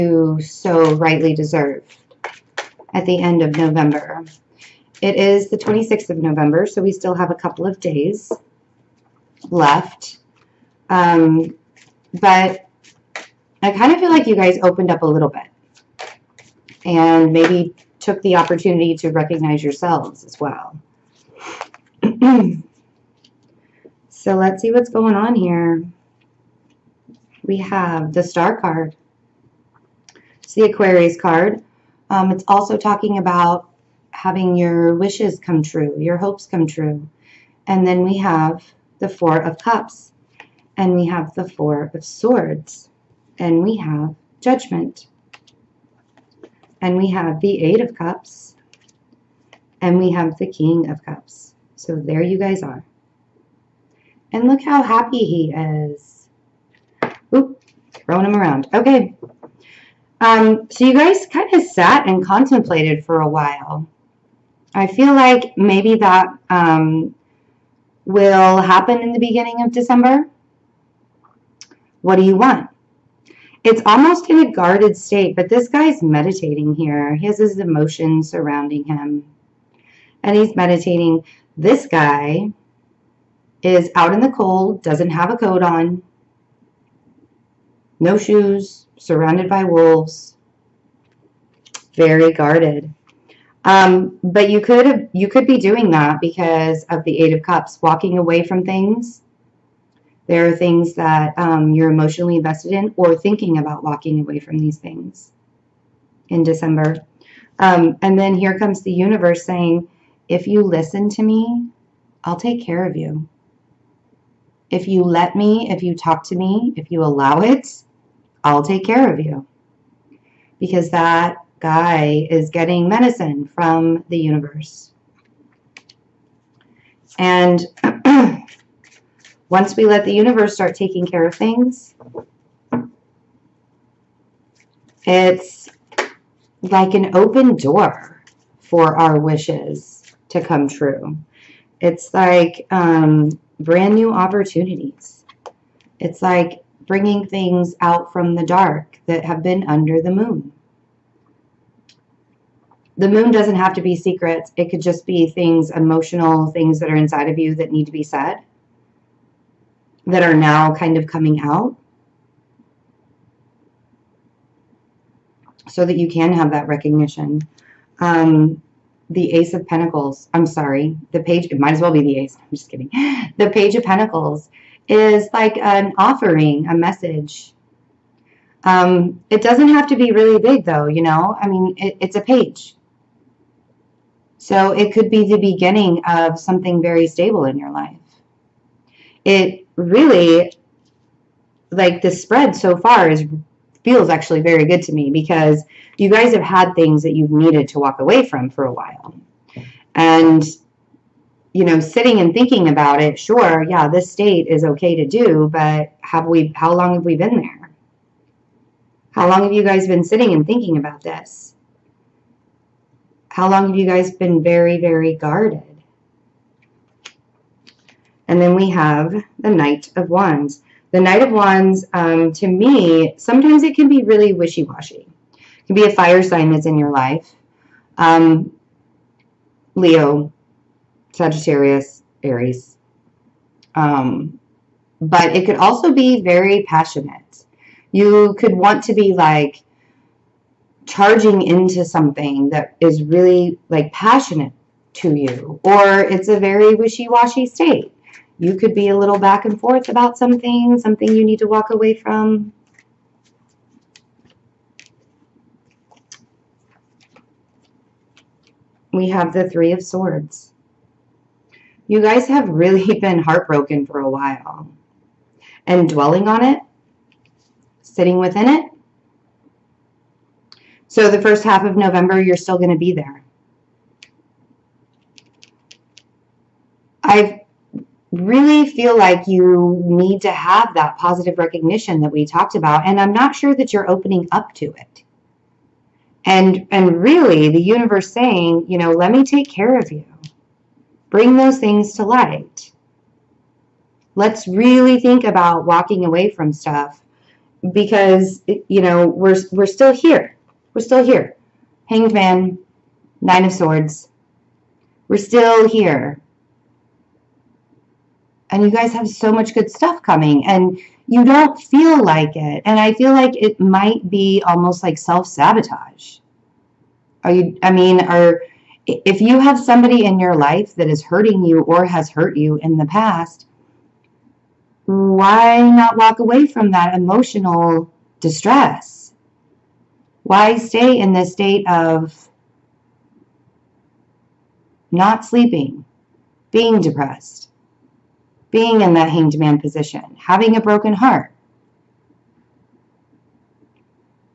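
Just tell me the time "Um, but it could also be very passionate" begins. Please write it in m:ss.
3:53.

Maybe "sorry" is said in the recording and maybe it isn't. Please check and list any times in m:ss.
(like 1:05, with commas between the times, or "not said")
2:50.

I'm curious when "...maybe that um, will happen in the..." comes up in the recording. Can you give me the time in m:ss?
1:05.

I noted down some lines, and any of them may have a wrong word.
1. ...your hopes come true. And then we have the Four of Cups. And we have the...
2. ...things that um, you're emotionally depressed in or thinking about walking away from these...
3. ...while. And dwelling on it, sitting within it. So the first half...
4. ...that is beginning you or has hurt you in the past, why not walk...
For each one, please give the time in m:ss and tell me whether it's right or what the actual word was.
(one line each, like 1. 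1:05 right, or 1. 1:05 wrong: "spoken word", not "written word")
1. 0:35 right
2. 1:40 wrong: "invested", not "depressed"
3. 4:24 right
4. 5:20 wrong: "hurting", not "beginning".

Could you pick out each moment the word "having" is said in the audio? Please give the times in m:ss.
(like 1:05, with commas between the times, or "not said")
0:34, 5:40.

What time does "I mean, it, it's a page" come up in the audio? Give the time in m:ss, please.
3:01.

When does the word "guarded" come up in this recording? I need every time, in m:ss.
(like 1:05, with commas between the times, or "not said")
1:14, 1:32, 3:35.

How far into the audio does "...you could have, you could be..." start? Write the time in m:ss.
1:34.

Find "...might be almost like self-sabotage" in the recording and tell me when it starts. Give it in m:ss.
5:13.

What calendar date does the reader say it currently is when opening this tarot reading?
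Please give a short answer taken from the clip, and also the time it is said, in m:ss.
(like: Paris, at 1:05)
November 26, at 0:05.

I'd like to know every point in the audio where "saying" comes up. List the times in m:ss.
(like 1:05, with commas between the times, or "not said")
1:49, 4:48.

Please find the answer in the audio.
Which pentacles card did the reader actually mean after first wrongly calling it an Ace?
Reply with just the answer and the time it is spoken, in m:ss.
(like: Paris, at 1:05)
Page of Pentacles, at 2:53.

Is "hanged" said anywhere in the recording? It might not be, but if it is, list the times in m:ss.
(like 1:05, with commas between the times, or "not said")
5:01, 5:39.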